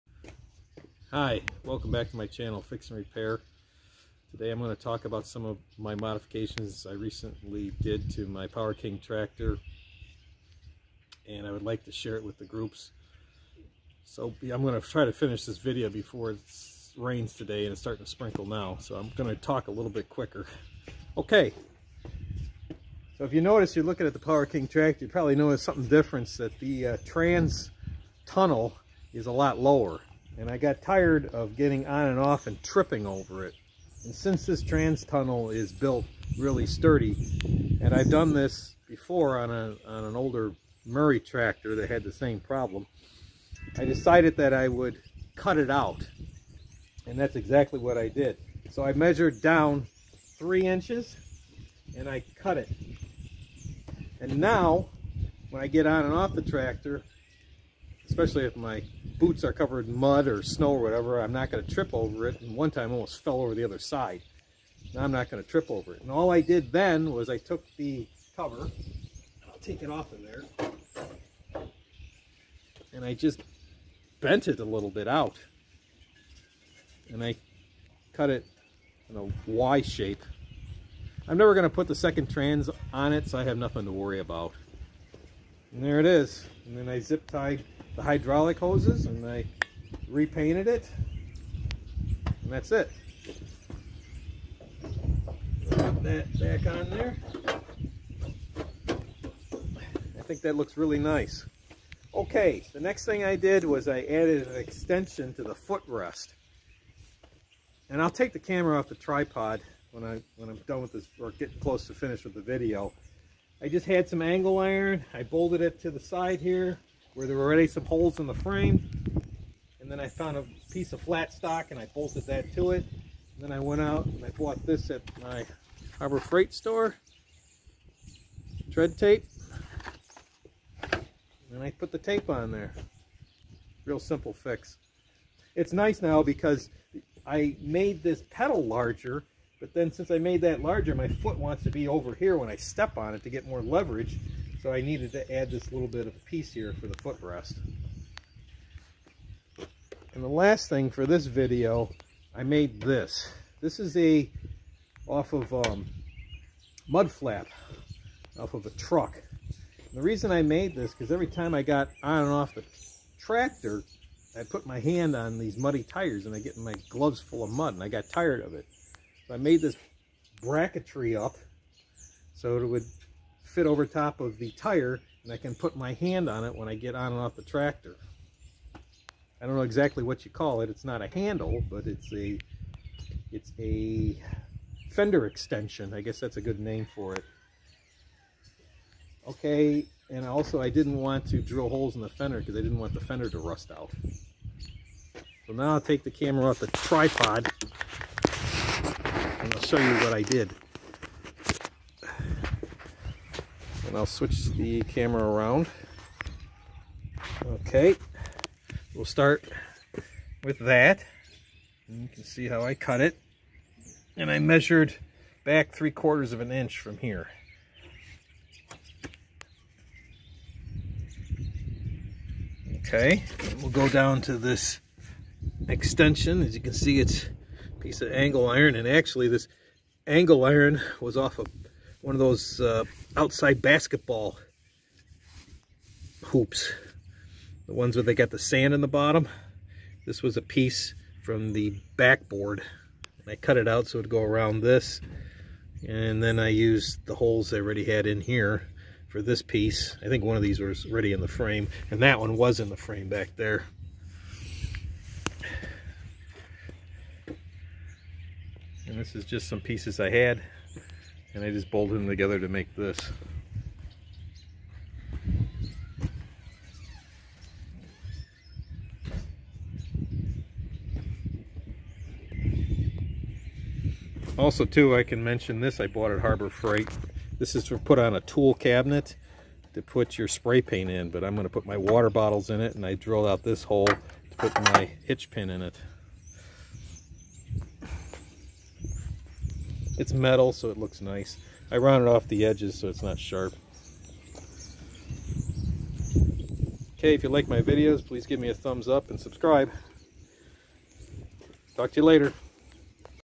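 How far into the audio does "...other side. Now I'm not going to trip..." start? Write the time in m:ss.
1:03.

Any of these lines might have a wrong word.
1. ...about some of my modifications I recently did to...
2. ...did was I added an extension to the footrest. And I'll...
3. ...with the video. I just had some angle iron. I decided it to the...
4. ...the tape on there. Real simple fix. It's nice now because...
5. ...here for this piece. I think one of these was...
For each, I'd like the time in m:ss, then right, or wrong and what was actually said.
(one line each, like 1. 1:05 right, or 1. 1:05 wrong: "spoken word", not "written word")
1. 0:05 right
2. 1:43 right
3. 1:52 wrong: "bolted", not "decided"
4. 2:11 right
5. 4:08 right.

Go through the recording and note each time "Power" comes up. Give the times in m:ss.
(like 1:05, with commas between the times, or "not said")
0:08, 0:24.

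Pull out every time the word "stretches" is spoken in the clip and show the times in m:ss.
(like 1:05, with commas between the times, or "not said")
not said.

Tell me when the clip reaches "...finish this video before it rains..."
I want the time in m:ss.
0:15.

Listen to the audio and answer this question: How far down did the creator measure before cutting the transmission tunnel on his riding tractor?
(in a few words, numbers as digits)
3 inches.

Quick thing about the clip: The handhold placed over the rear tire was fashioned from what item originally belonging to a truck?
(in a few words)
mud flap.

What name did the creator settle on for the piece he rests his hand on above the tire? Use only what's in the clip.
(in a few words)
fender extension.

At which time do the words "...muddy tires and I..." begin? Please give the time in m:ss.
2:45.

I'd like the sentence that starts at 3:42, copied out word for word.
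Okay, we'll go down to this extension.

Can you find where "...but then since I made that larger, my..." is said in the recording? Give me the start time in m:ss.
2:19.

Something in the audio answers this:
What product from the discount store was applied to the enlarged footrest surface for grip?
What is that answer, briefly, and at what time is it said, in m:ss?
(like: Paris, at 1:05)
Tread tape, at 2:08.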